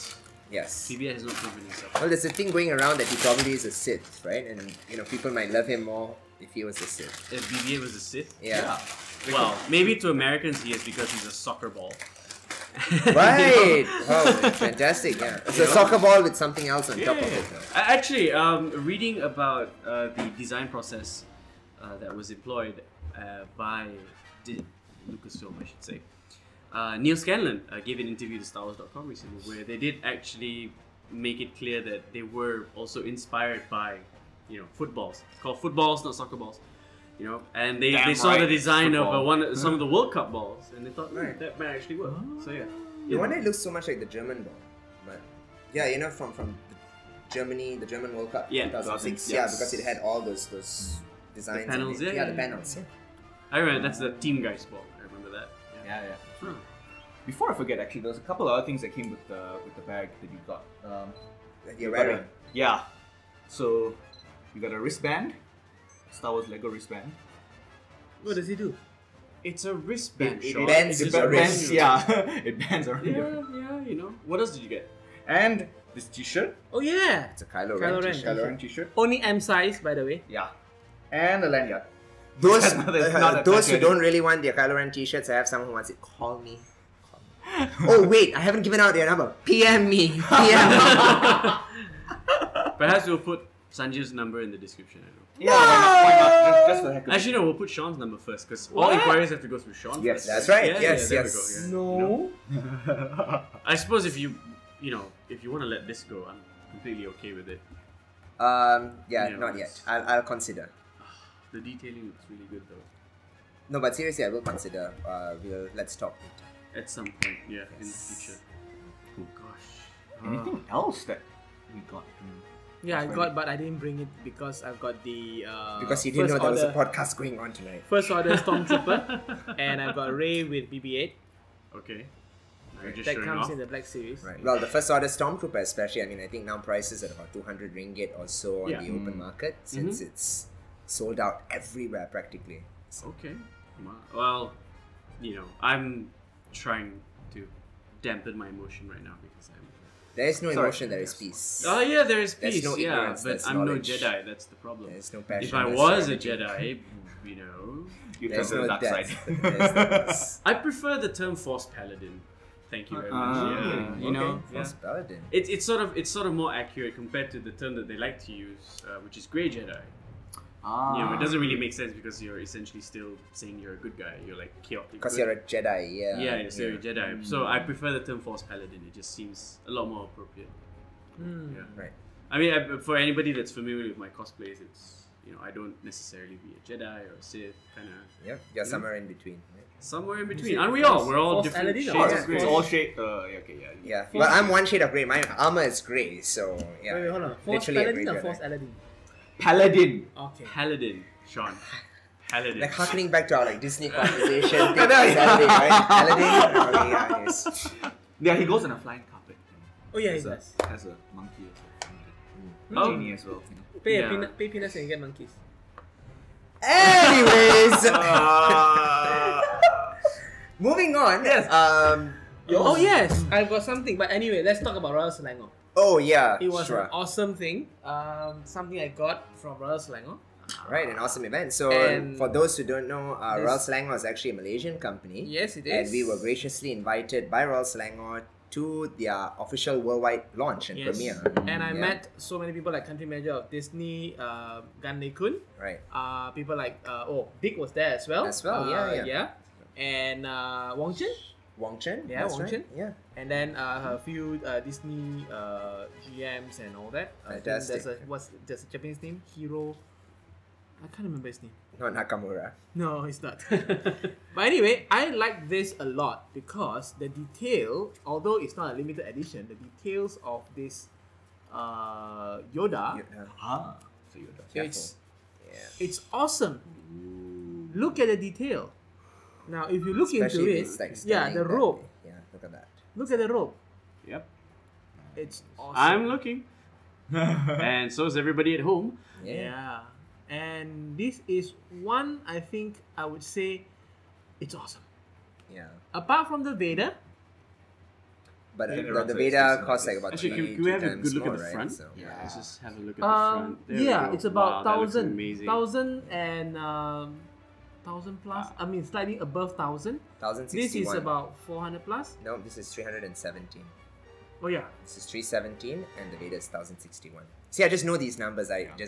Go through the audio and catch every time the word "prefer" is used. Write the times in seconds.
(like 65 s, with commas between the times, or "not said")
160 s, 177 s.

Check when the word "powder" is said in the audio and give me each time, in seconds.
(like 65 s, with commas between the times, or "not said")
not said.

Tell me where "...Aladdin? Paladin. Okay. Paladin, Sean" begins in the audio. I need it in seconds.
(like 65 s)
198 s.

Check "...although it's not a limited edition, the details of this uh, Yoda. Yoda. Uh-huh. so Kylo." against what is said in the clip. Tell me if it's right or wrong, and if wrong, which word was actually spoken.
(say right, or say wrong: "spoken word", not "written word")
wrong: "Yoda", not "Kylo".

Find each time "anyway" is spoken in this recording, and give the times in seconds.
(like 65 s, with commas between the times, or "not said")
216 s, 224 s, 264 s.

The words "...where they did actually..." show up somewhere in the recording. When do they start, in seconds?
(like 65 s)
29 s.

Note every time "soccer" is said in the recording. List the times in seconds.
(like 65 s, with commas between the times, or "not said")
11 s, 15 s, 36 s.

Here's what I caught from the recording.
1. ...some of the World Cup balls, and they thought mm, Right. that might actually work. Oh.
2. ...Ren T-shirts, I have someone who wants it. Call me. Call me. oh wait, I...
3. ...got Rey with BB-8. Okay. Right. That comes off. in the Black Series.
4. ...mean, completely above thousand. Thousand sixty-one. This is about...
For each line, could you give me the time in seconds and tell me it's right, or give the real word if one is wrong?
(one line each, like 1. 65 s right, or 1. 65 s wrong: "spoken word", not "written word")
1. 39 s right
2. 84 s right
3. 129 s right
4. 308 s wrong: "slightly", not "completely".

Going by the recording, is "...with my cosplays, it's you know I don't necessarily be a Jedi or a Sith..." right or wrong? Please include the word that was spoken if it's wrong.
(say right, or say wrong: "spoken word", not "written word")
right.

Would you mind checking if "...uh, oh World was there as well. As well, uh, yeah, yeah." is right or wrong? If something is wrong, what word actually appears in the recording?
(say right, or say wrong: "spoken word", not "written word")
wrong: "Dick", not "World".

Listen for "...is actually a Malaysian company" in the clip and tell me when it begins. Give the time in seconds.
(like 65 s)
233 s.